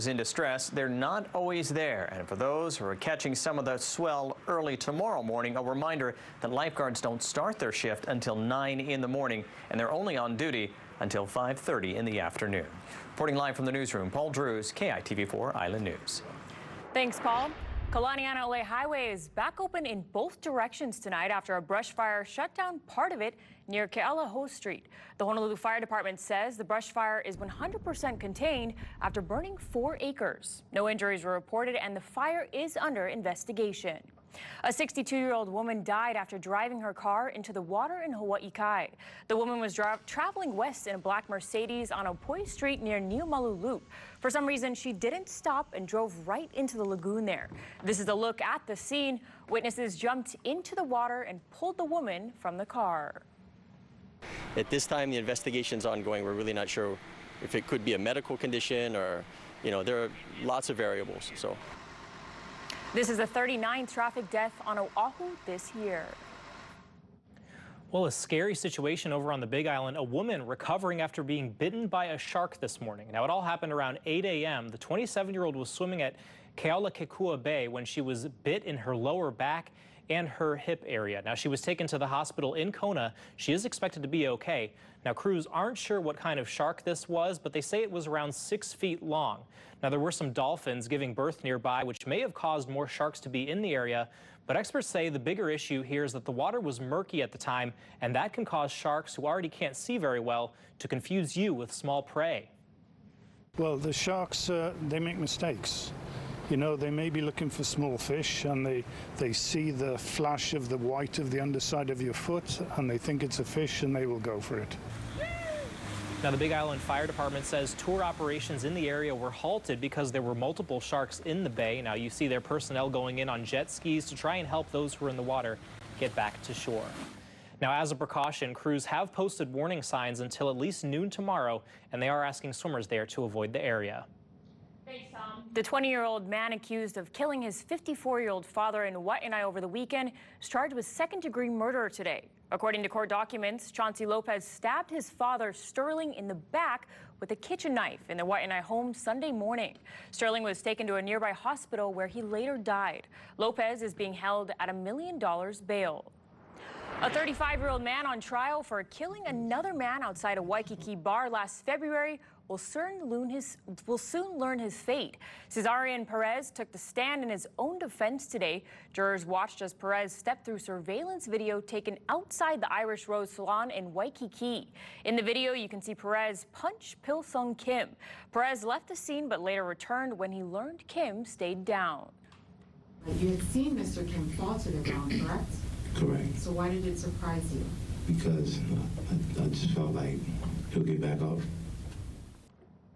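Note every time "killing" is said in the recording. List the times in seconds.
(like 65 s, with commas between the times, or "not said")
137 s, 158 s.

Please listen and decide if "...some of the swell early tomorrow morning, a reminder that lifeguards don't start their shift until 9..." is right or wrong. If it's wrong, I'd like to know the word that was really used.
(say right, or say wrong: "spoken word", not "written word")
right.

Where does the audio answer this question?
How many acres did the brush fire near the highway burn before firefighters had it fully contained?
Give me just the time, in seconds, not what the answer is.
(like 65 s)
29 s.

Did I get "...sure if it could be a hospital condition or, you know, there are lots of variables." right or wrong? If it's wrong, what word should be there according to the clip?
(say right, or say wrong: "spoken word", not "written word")
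wrong: "medical", not "hospital".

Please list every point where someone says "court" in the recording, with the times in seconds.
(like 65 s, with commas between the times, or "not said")
142 s.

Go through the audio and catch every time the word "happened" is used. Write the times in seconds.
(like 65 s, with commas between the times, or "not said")
73 s.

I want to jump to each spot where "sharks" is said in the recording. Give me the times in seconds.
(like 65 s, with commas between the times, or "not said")
72 s, 86 s, 92 s, 98 s, 103 s, 120 s.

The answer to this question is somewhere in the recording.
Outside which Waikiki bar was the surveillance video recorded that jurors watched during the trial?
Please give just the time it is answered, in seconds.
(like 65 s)
172 s.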